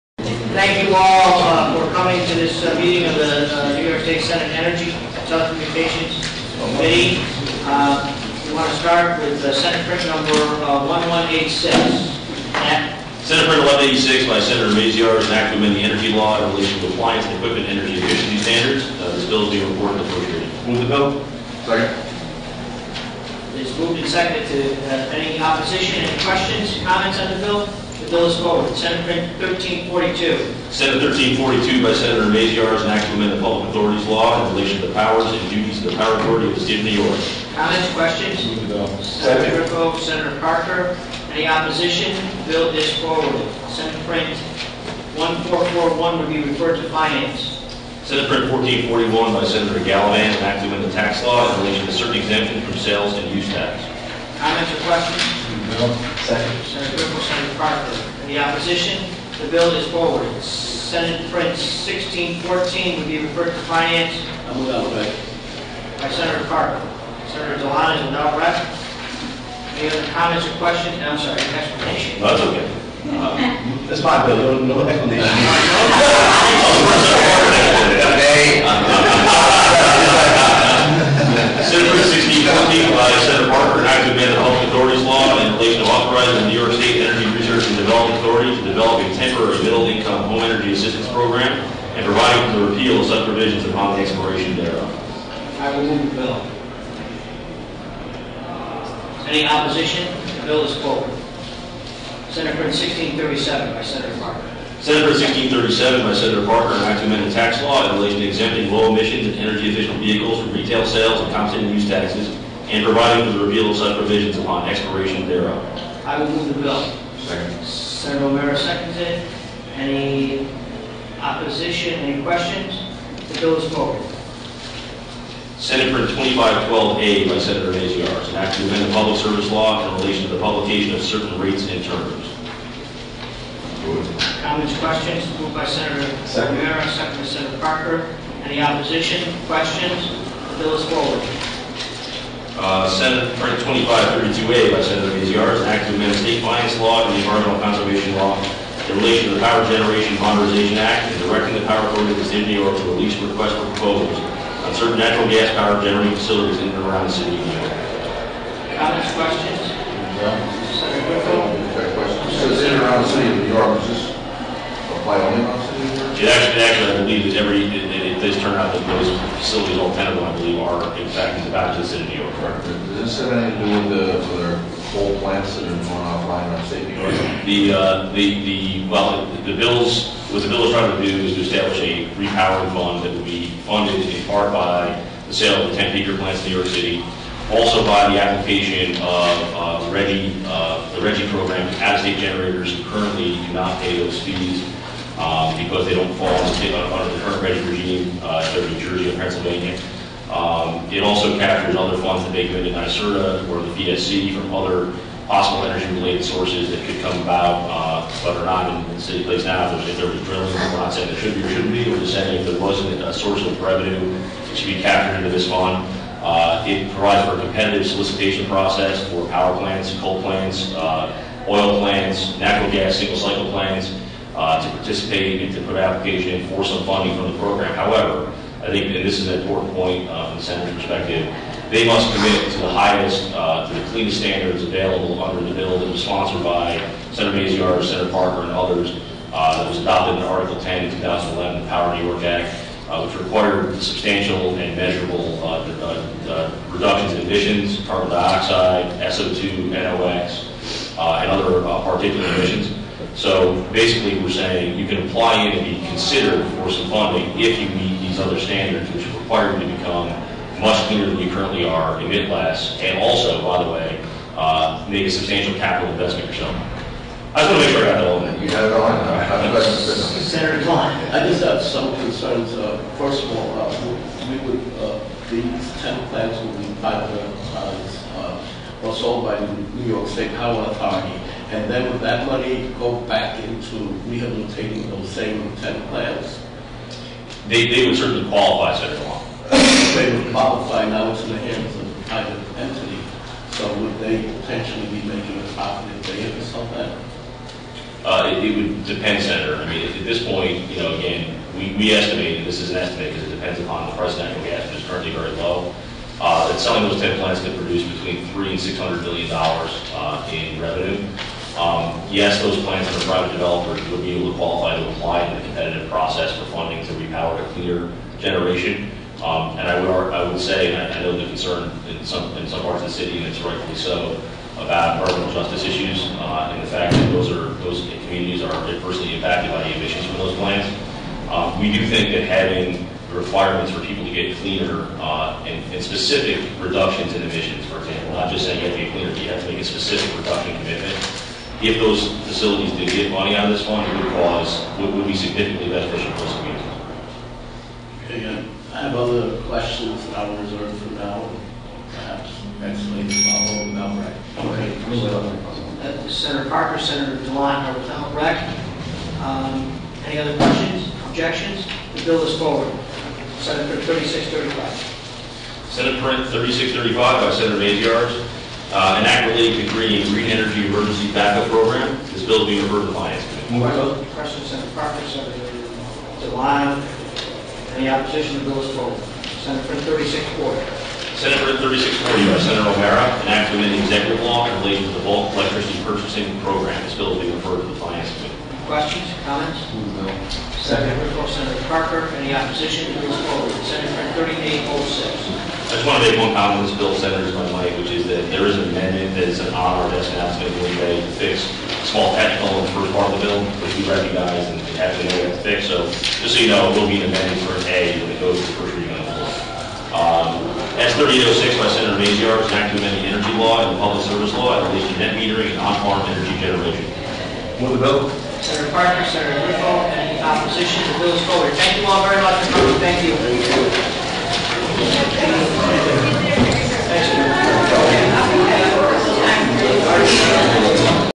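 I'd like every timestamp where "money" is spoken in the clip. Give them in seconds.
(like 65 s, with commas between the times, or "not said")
282 s, 343 s.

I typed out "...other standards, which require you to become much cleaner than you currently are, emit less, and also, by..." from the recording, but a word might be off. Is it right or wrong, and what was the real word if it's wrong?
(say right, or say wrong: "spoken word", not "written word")
right.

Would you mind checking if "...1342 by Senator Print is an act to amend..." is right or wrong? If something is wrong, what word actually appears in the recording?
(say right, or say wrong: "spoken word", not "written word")
wrong: "Maziarz", not "Print".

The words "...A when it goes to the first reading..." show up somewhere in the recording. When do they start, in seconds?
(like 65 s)
407 s.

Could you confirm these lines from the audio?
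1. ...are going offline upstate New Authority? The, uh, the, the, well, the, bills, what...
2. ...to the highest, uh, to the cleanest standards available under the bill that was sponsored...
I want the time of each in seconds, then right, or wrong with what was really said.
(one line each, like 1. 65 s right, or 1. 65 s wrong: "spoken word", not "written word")
1. 175 s wrong: "York", not "Authority"
2. 232 s right.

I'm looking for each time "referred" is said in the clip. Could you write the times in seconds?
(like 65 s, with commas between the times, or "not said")
46 s, 63 s, 372 s, 387 s.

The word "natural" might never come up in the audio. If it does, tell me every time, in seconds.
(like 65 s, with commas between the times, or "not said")
154 s, 222 s, 304 s.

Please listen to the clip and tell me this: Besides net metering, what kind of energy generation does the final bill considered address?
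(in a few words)
On-farm energy generation.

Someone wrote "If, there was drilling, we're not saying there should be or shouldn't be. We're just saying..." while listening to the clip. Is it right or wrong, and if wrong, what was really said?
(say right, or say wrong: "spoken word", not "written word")
right.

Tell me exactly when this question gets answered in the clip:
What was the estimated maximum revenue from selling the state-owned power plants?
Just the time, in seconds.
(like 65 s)
308 s.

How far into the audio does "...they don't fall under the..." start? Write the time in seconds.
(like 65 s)
195 s.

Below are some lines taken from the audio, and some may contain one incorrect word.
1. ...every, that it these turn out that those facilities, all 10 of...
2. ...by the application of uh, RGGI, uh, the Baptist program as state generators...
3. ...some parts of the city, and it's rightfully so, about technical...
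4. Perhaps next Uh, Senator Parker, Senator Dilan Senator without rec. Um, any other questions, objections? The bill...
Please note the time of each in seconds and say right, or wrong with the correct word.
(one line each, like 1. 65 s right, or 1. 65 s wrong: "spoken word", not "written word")
1. 167 s right
2. 187 s wrong: "RGGI", not "Baptist"
3. 322 s wrong: "environmental", not "technical"
4. 351 s right.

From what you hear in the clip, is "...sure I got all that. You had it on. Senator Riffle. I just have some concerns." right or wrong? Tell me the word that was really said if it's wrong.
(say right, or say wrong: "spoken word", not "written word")
wrong: "Klein", not "Riffle".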